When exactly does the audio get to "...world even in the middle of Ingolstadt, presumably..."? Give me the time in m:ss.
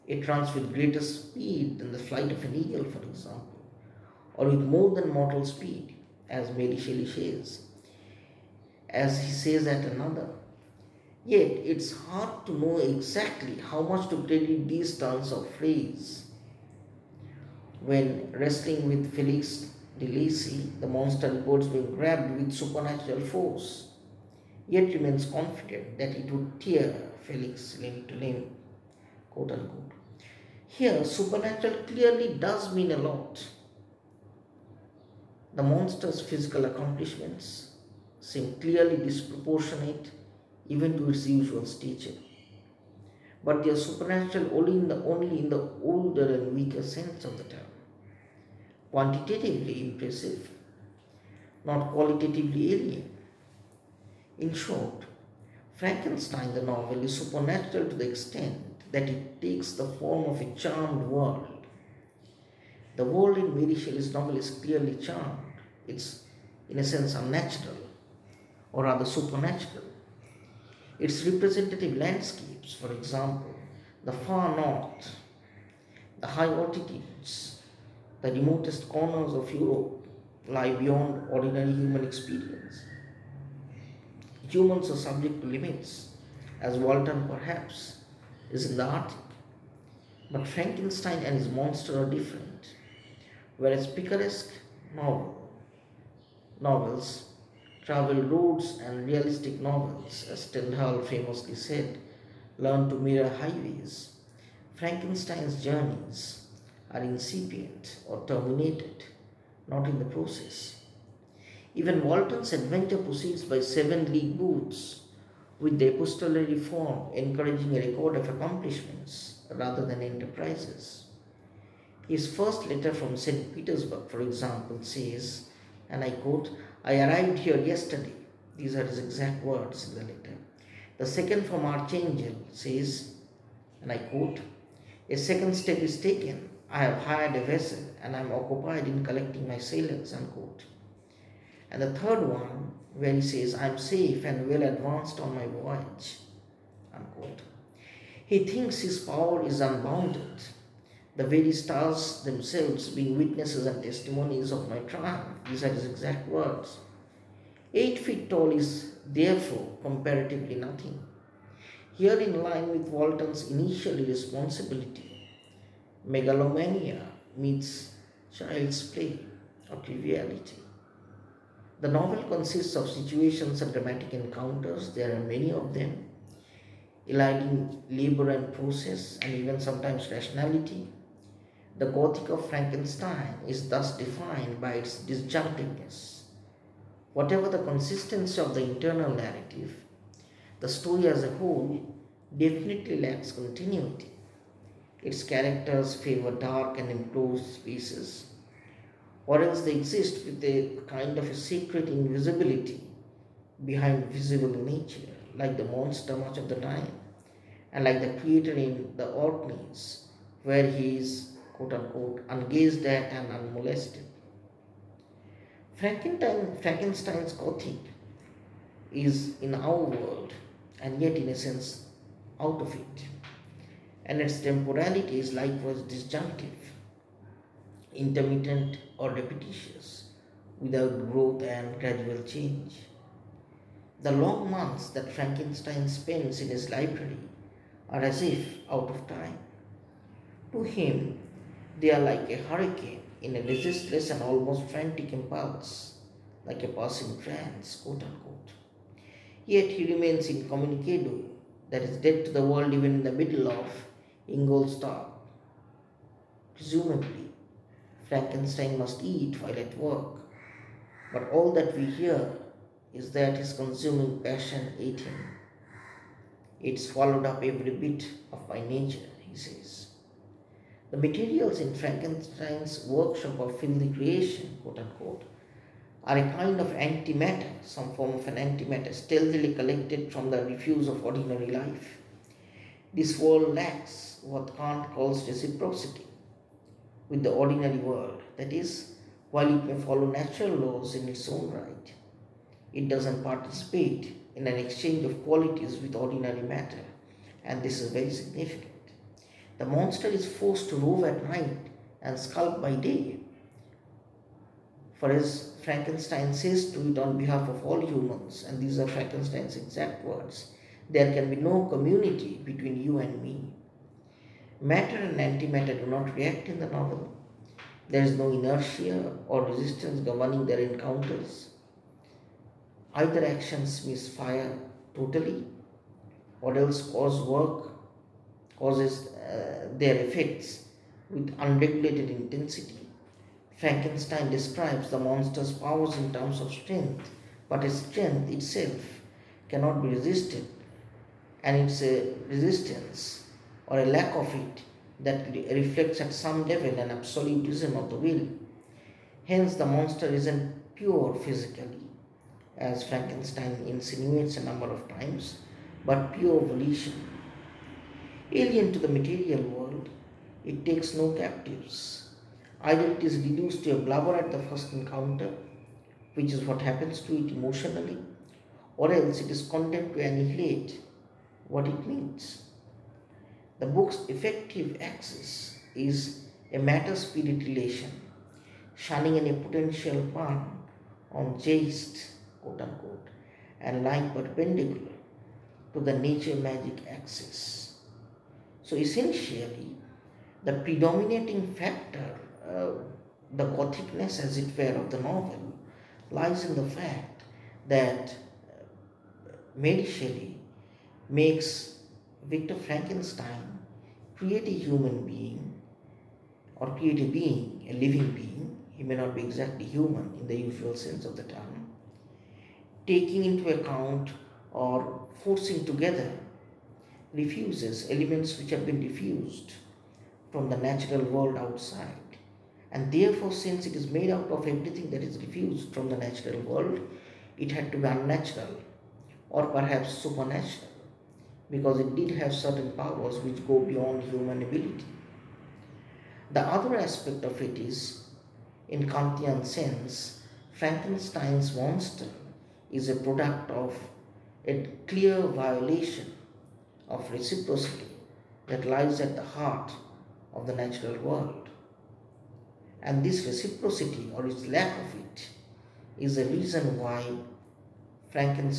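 4:12.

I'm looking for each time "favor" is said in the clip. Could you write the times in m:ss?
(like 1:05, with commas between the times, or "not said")
3:15.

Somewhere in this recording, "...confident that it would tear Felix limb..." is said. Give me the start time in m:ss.
0:25.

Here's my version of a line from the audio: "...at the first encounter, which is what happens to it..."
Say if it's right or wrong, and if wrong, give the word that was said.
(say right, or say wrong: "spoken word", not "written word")
right.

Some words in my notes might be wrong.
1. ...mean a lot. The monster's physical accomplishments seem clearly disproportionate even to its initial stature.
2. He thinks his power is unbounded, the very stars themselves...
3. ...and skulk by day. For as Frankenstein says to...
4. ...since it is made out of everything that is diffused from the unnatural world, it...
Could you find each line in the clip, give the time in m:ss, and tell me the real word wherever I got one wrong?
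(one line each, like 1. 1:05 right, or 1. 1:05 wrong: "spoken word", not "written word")
1. 0:32 wrong: "usual", not "initial"
2. 2:28 right
3. 5:02 right
4. 7:03 wrong: "natural", not "unnatural".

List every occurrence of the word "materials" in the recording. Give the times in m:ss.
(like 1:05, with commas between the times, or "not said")
4:30, 5:58.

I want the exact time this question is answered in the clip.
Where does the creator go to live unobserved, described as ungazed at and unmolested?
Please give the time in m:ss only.
3:29.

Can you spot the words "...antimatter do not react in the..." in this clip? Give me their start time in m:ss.
5:15.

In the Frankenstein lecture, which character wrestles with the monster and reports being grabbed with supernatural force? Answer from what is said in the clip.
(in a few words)
Felix de Lacey.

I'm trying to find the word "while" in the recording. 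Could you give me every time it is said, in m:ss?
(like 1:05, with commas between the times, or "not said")
4:19, 4:49.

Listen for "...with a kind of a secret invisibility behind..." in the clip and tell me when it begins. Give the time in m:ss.
3:20.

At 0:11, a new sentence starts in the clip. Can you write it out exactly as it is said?
Yet it's hard to know exactly how much to credit these turns of phrase.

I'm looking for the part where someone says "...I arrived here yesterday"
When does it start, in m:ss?
2:06.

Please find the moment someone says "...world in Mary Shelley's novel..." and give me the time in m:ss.
1:03.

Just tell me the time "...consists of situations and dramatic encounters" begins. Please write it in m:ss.
2:52.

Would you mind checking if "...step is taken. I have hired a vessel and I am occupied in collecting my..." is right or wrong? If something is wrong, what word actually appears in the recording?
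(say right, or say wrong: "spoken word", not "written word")
right.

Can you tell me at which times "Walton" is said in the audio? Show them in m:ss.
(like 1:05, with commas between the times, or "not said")
1:26, 1:52, 2:42.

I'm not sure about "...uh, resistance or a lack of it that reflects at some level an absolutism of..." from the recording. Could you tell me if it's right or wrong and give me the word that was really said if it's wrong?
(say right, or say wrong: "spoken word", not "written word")
right.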